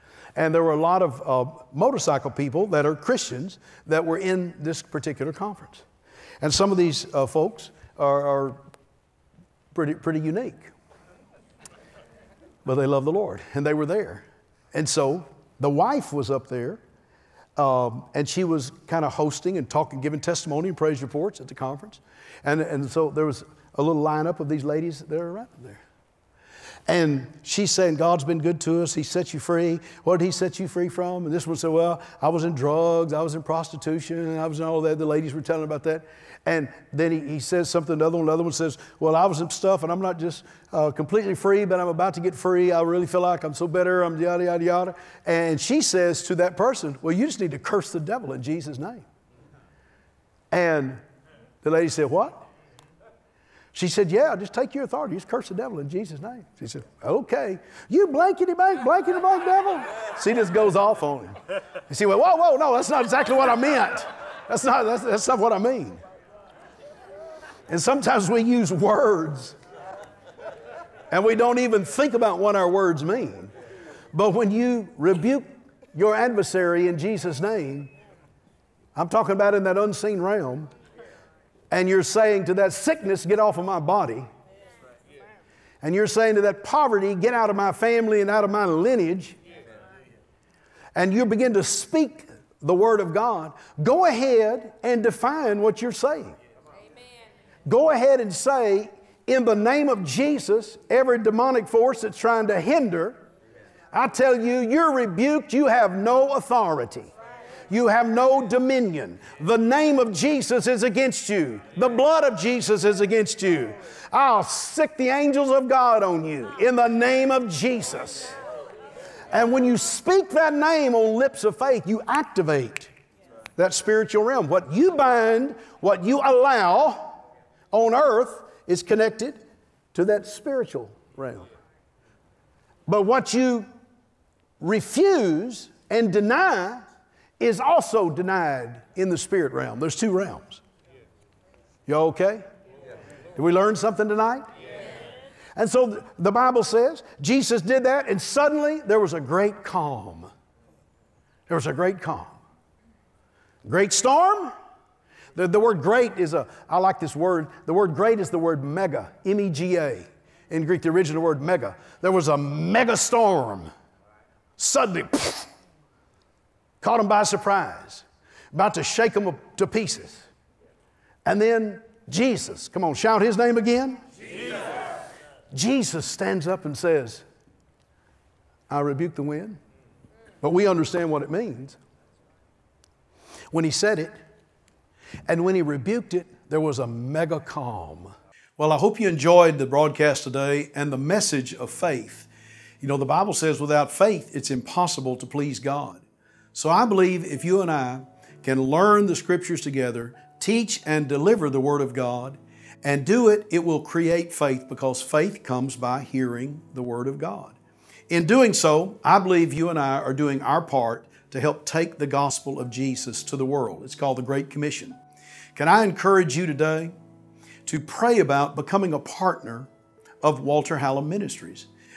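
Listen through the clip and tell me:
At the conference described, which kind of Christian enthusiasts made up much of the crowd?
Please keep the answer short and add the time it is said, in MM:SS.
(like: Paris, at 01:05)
motorcycle people, at 00:01.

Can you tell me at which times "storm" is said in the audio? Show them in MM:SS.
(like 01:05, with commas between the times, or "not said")
02:33, 02:42.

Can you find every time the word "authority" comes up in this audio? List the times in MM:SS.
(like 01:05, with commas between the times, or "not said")
00:54, 01:46.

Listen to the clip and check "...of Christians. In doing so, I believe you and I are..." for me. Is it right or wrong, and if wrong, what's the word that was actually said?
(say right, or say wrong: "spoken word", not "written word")
wrong: "God", not "Christians".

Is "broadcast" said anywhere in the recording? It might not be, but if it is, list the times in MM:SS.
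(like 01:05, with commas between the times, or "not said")
03:09.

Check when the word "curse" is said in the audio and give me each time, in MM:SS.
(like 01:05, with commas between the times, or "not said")
00:47, 00:55.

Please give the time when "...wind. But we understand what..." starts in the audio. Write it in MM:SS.
02:59.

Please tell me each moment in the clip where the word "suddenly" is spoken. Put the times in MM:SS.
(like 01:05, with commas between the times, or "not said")
02:28, 02:44.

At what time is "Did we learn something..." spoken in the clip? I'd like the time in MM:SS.
02:23.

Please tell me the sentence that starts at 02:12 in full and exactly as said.
But what you refuse and deny is also denied in the spirit realm.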